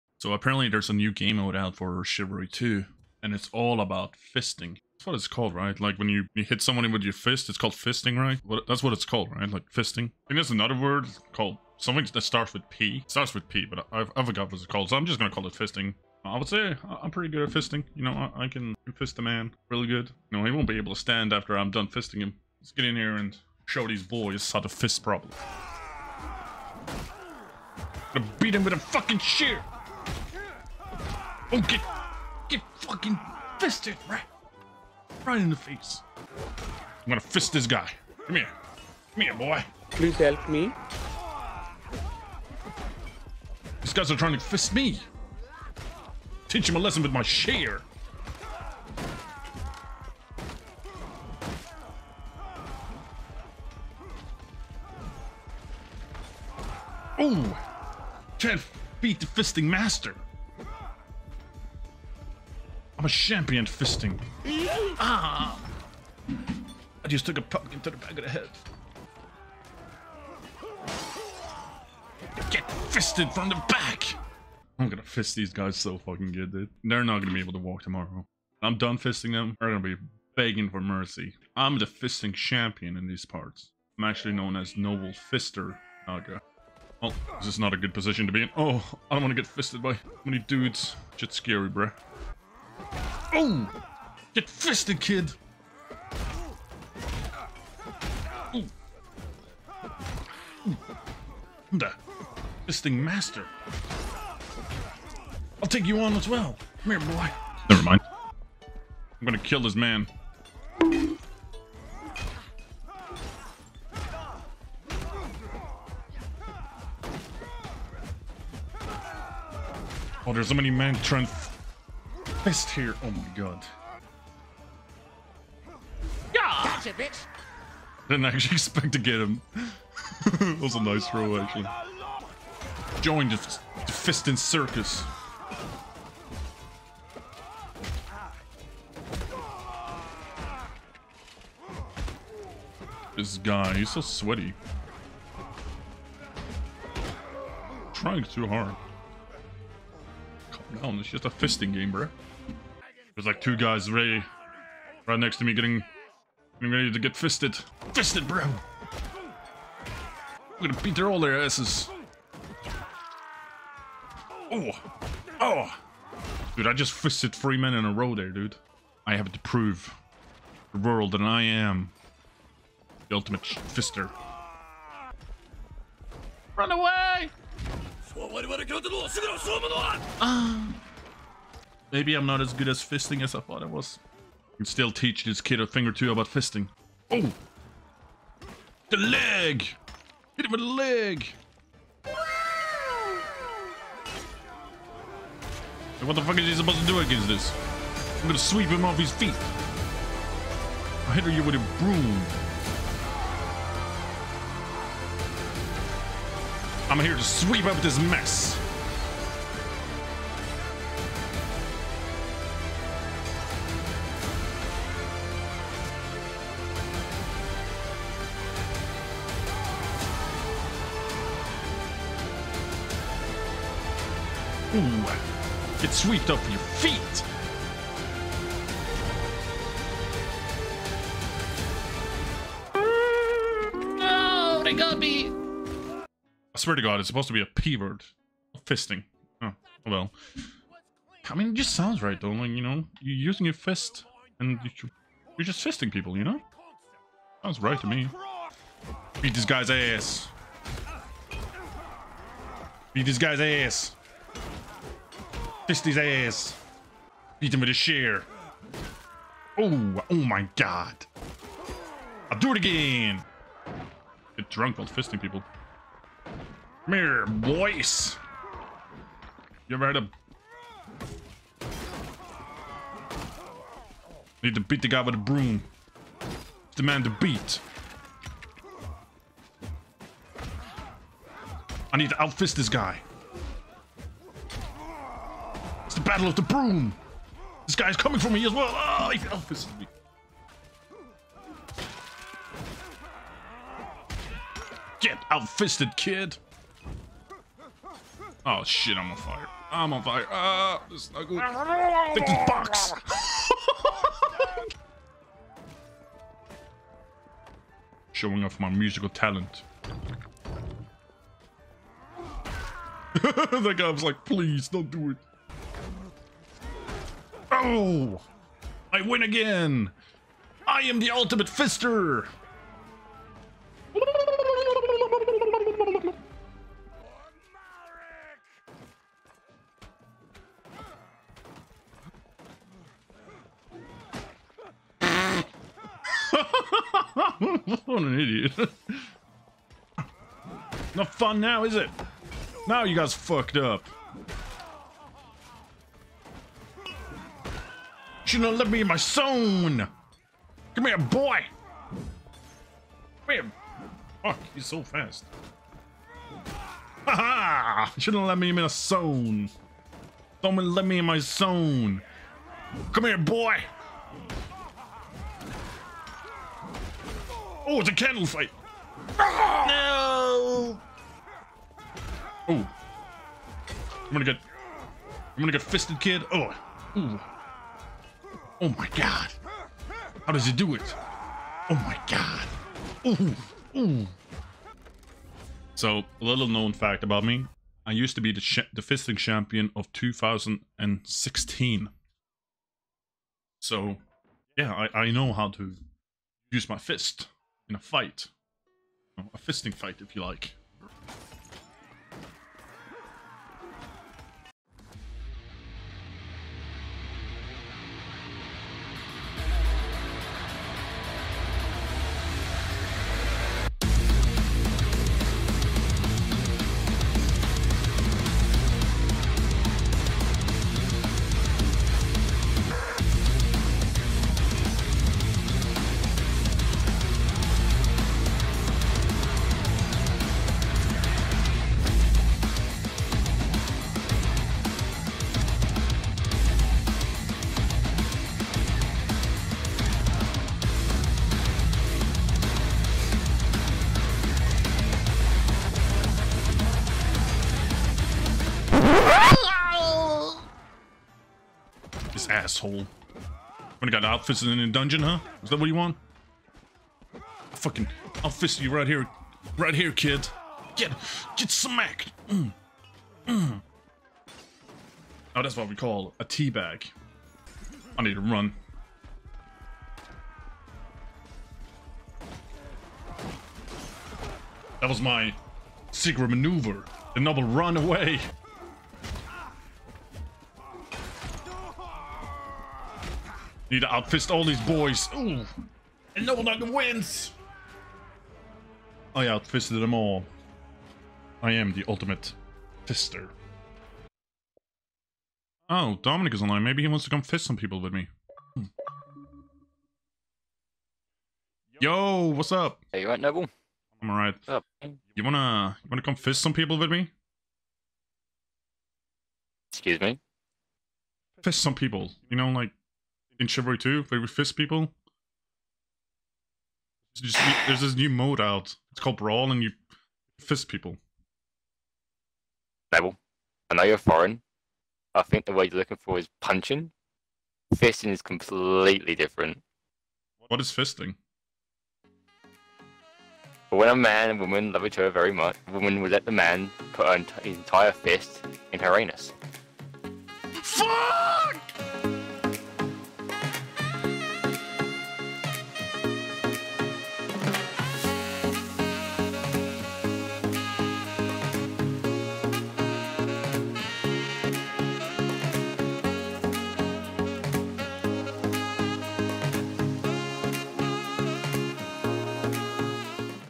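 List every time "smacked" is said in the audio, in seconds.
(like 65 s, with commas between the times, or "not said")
461 s.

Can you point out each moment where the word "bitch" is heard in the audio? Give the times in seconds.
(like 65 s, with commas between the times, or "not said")
126 s.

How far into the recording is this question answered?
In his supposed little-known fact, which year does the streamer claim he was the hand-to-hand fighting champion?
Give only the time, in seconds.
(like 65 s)
389 s.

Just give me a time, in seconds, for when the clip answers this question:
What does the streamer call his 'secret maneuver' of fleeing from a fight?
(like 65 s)
477 s.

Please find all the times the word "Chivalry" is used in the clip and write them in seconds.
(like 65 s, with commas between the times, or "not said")
2 s, 513 s.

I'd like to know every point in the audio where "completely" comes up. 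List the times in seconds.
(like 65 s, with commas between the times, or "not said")
528 s.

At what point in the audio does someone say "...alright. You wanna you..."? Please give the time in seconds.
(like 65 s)
504 s.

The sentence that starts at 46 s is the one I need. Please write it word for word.
Teach him a lesson with my share.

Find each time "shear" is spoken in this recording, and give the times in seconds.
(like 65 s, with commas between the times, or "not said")
29 s, 257 s.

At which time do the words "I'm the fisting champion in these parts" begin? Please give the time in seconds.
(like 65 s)
81 s.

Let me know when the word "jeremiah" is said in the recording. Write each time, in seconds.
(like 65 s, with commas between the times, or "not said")
not said.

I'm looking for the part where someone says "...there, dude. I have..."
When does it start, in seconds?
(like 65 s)
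168 s.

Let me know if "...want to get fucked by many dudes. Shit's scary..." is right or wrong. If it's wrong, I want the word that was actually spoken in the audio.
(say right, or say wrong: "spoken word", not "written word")
wrong: "fisted", not "fucked".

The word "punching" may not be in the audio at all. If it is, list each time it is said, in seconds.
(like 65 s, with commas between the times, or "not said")
526 s.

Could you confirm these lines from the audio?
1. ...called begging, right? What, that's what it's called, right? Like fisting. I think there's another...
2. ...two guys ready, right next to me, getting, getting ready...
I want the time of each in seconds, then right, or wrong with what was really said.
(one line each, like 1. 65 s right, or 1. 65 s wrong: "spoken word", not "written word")
1. 7 s wrong: "fisting", not "begging"
2. 153 s right.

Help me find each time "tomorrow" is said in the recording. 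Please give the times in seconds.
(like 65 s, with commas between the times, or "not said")
77 s.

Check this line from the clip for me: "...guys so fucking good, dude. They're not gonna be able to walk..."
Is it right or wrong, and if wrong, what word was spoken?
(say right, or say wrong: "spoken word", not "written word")
right.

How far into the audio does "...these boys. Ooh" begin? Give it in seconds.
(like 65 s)
484 s.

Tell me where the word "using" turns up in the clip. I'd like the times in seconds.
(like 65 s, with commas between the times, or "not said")
243 s.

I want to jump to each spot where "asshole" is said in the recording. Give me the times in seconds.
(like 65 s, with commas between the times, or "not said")
452 s.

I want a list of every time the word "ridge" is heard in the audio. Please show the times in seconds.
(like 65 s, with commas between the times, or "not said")
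not said.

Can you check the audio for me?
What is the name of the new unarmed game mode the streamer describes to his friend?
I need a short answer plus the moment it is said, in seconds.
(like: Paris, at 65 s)
Brawl, at 519 s.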